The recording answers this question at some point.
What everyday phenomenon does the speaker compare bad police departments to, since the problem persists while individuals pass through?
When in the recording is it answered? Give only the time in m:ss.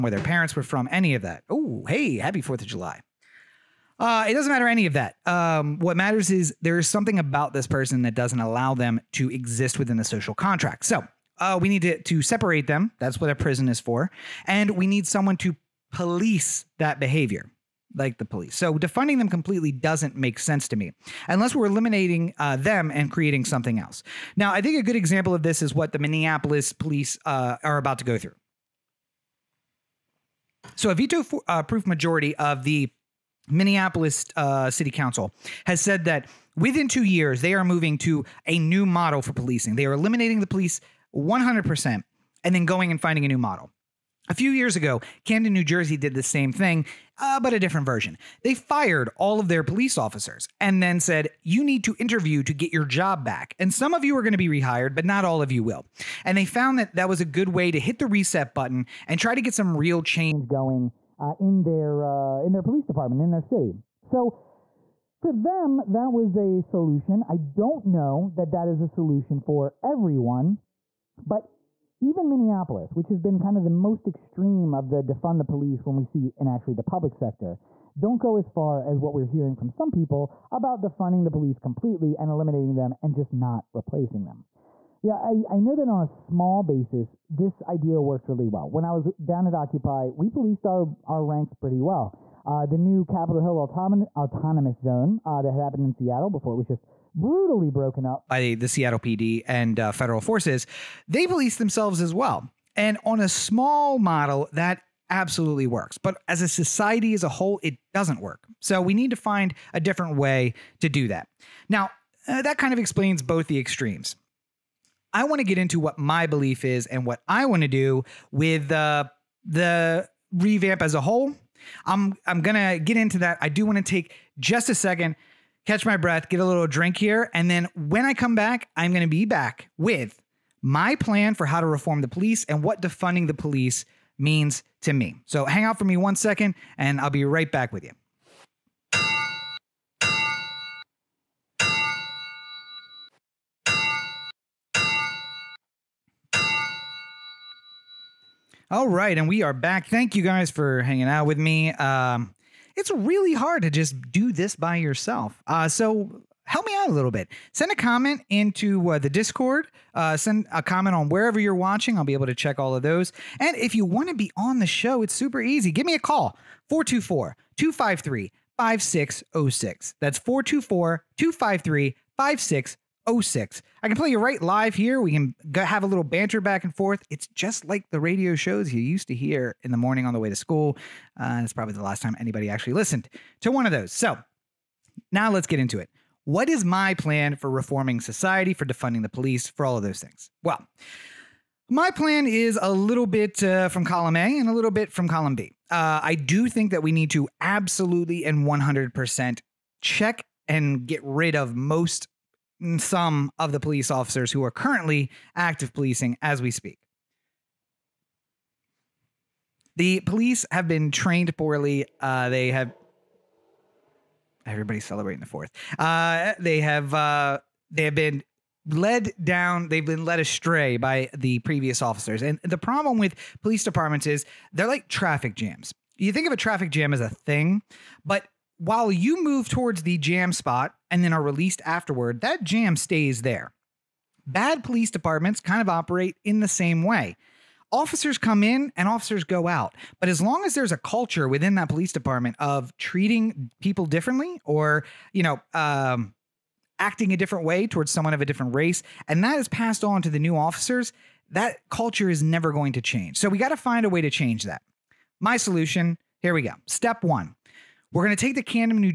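3:44.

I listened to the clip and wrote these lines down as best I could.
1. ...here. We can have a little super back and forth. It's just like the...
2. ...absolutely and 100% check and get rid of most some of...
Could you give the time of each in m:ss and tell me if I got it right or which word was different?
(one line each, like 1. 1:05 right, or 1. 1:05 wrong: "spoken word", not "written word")
1. 2:54 wrong: "banter", not "super"
2. 3:17 right.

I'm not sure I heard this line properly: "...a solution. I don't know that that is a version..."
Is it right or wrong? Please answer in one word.
wrong.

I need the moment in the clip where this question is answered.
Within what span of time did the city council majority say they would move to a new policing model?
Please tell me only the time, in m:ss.
0:36.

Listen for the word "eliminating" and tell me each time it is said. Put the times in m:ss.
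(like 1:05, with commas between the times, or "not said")
0:21, 0:39, 1:22.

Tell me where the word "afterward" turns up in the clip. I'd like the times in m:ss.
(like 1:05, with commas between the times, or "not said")
3:51.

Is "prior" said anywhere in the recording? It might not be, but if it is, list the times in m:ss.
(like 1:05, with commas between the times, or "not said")
not said.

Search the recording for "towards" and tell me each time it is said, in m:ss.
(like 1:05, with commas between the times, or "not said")
3:49, 4:07.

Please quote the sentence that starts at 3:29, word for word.
The police have been trained poorly.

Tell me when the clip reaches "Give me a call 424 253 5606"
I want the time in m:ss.
2:45.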